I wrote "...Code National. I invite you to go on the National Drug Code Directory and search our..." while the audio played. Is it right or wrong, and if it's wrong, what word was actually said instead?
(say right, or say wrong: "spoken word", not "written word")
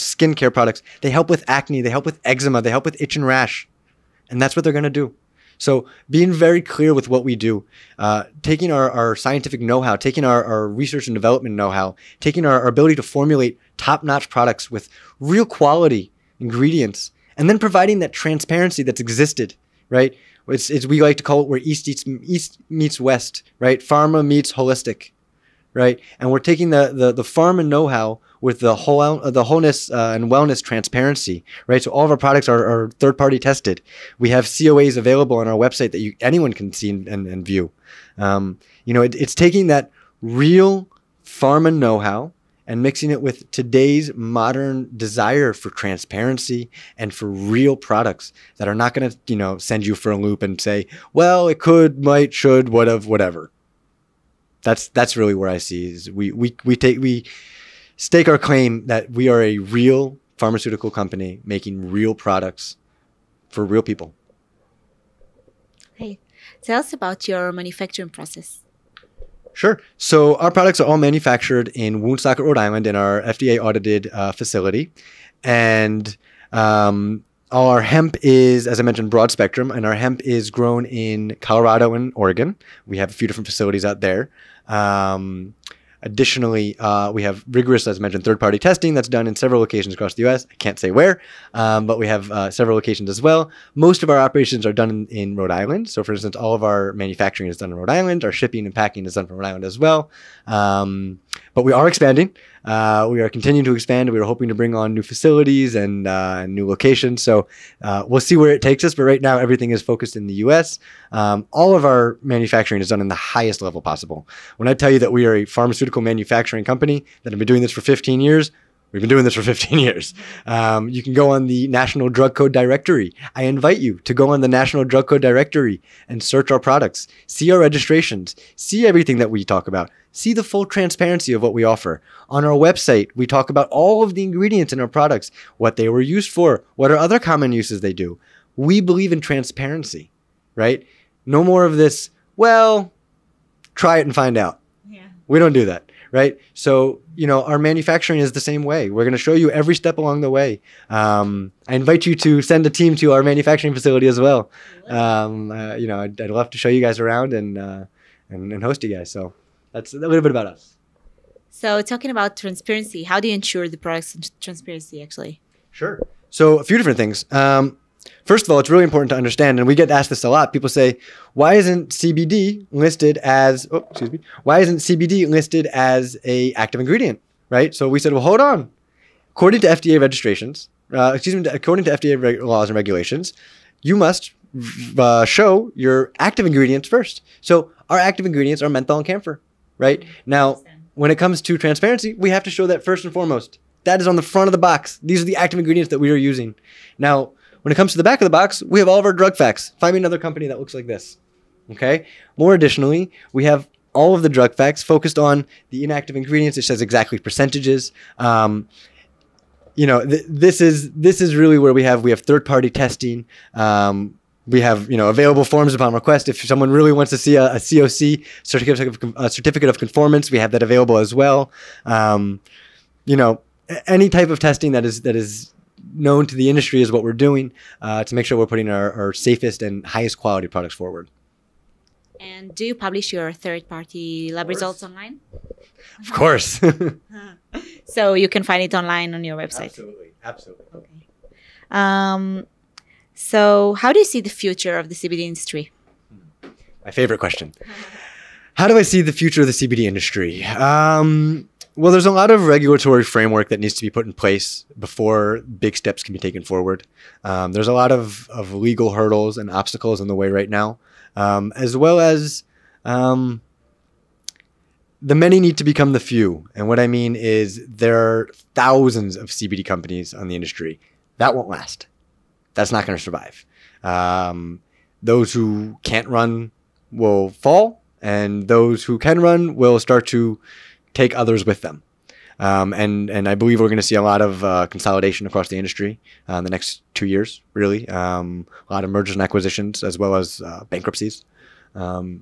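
wrong: "Directory", not "National".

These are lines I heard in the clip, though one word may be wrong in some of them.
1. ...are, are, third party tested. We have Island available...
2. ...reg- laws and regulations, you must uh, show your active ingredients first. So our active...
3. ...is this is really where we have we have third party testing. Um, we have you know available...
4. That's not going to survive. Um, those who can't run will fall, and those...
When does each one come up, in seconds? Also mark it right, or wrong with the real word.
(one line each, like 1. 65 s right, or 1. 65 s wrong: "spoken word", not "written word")
1. 32 s wrong: "COAs", not "Island"
2. 182 s right
3. 210 s right
4. 272 s right.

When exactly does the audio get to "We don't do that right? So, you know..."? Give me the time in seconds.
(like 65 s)
145 s.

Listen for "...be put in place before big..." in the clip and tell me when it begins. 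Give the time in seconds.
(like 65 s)
253 s.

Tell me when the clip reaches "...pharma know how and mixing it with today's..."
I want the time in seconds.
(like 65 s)
41 s.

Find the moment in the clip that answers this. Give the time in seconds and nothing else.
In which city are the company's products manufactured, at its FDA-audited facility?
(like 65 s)
72 s.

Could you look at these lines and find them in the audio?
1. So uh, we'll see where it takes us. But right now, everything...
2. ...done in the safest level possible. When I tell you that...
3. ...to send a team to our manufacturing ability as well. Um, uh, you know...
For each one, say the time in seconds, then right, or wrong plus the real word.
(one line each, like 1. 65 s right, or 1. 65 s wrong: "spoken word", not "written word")
1. 107 s right
2. 112 s wrong: "highest", not "safest"
3. 152 s wrong: "facility", not "ability".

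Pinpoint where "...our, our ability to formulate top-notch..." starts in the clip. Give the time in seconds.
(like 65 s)
12 s.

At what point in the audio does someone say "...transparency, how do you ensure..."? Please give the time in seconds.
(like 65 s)
162 s.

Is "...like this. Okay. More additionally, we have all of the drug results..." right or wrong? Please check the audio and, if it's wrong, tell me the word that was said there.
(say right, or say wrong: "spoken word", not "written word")
wrong: "facts", not "results".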